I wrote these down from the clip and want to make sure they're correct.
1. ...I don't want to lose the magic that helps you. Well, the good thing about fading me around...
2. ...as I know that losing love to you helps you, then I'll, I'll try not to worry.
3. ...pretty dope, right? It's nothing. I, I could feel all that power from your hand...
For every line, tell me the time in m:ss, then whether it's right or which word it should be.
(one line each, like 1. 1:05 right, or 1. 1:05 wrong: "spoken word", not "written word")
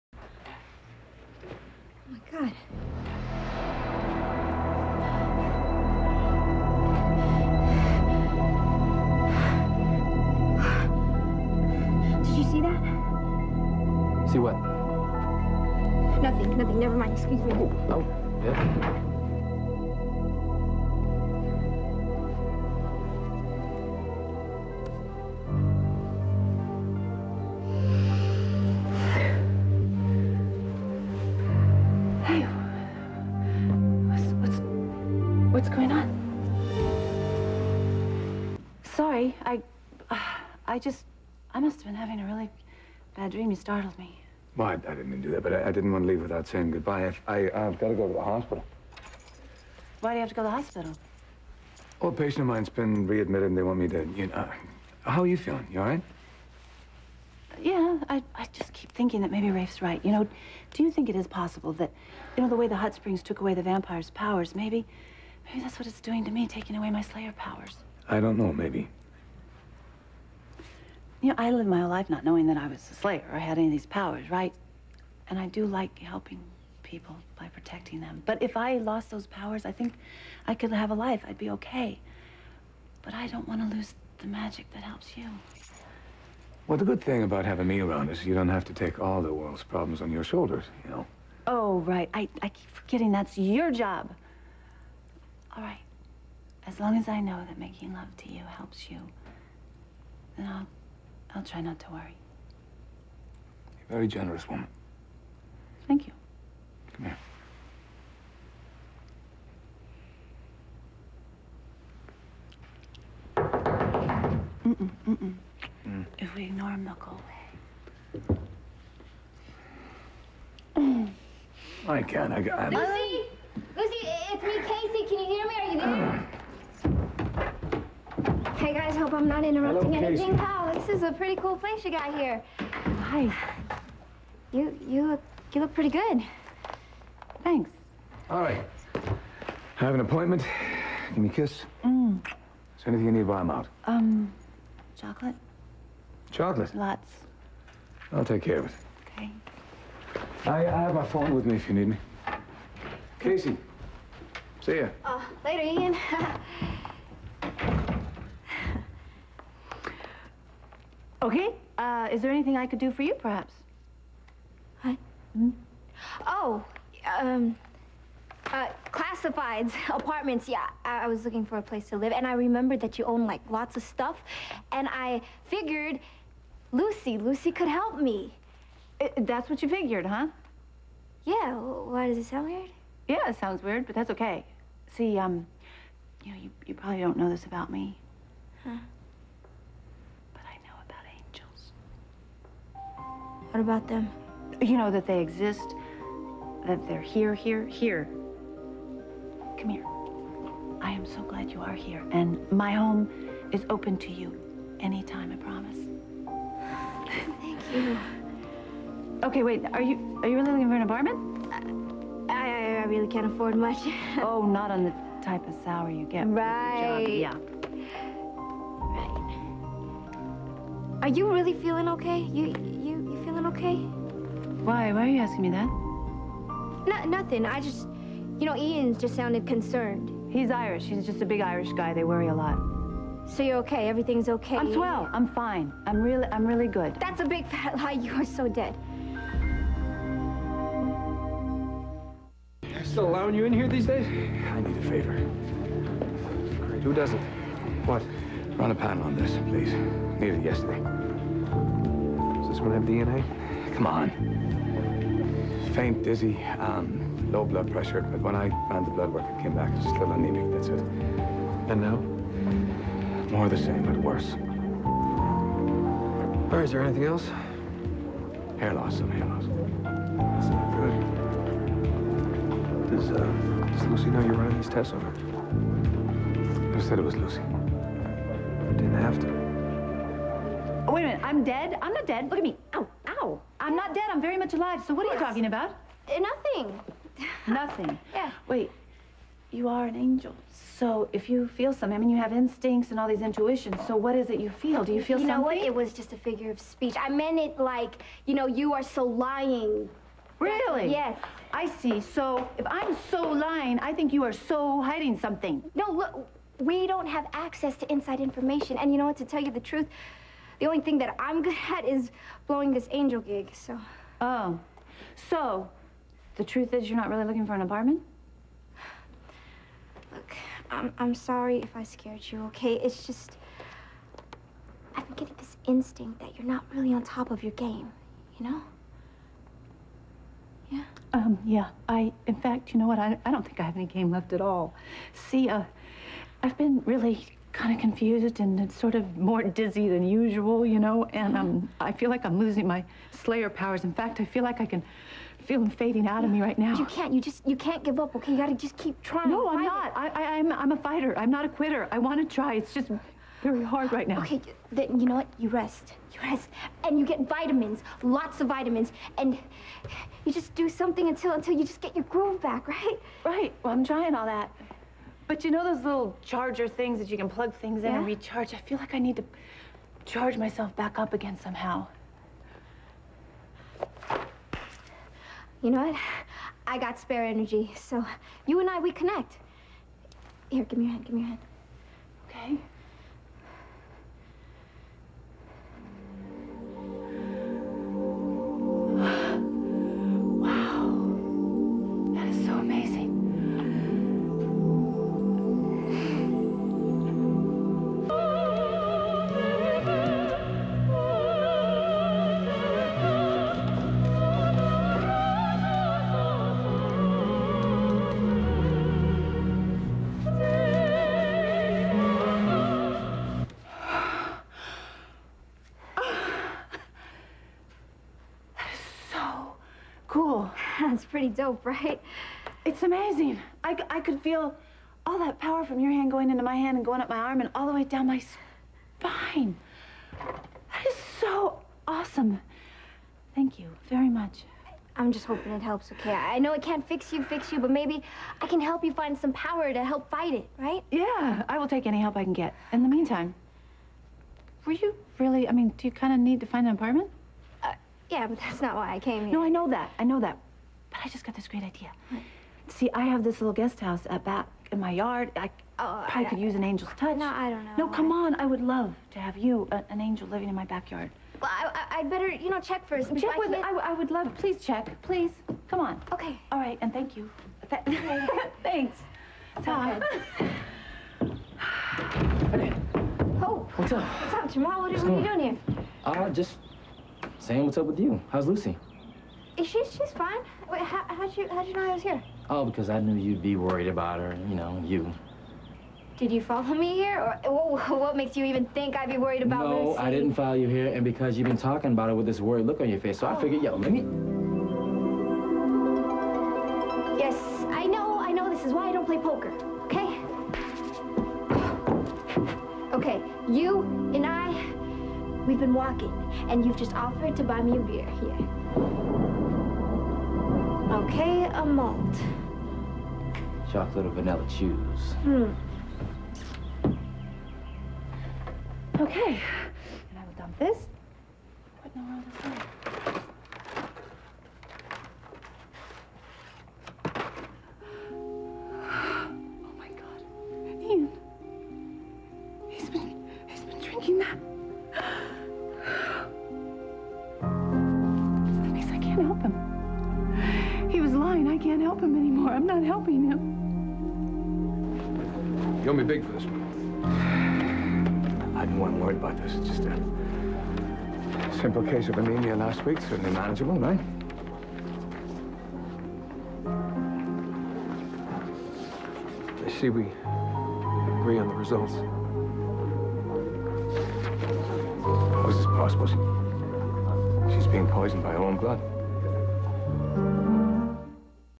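1. 1:23 wrong: "having", not "fading"
2. 1:36 wrong: "making", not "losing"
3. 7:01 wrong: "amazing", not "nothing".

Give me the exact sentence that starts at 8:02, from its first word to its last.
Oh, because I knew you'd be worried about her.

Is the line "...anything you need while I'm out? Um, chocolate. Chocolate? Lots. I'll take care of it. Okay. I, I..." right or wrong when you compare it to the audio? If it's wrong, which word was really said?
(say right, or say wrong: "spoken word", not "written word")
right.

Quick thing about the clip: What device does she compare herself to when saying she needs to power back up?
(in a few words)
charger.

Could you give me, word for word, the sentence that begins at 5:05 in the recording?
No, look, we don't have access to inside information.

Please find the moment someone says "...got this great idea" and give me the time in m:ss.
7:31.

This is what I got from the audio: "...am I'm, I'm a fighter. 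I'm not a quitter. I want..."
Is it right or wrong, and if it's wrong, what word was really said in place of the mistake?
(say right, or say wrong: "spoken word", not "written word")
right.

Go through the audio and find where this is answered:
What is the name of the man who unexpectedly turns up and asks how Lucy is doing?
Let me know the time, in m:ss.
7:54.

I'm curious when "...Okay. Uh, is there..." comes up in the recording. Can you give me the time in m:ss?
2:41.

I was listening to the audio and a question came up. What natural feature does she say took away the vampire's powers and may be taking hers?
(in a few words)
the hot springs.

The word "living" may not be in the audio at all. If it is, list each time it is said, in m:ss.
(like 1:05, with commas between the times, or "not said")
7:40.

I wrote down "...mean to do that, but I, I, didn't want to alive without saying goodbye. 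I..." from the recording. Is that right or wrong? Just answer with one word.
wrong.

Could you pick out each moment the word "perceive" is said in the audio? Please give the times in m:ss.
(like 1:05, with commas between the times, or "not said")
not said.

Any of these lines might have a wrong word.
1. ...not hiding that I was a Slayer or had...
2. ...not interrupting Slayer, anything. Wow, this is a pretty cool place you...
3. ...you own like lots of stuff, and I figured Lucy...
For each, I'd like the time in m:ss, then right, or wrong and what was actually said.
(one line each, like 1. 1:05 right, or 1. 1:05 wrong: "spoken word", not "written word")
1. 1:12 wrong: "knowing", not "hiding"
2. 2:09 wrong: "Hello", not "Slayer"
3. 2:52 right.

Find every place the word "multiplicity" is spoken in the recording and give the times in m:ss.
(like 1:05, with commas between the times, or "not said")
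not said.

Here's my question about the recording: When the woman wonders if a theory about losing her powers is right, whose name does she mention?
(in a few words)
Rafe.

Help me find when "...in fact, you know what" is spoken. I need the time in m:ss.
5:32.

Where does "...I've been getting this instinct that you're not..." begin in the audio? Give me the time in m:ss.
5:24.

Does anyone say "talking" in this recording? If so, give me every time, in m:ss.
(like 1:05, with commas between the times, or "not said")
4:45, 8:11.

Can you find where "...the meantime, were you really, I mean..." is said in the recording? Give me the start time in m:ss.
7:22.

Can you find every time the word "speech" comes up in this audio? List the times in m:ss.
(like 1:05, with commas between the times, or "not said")
4:56.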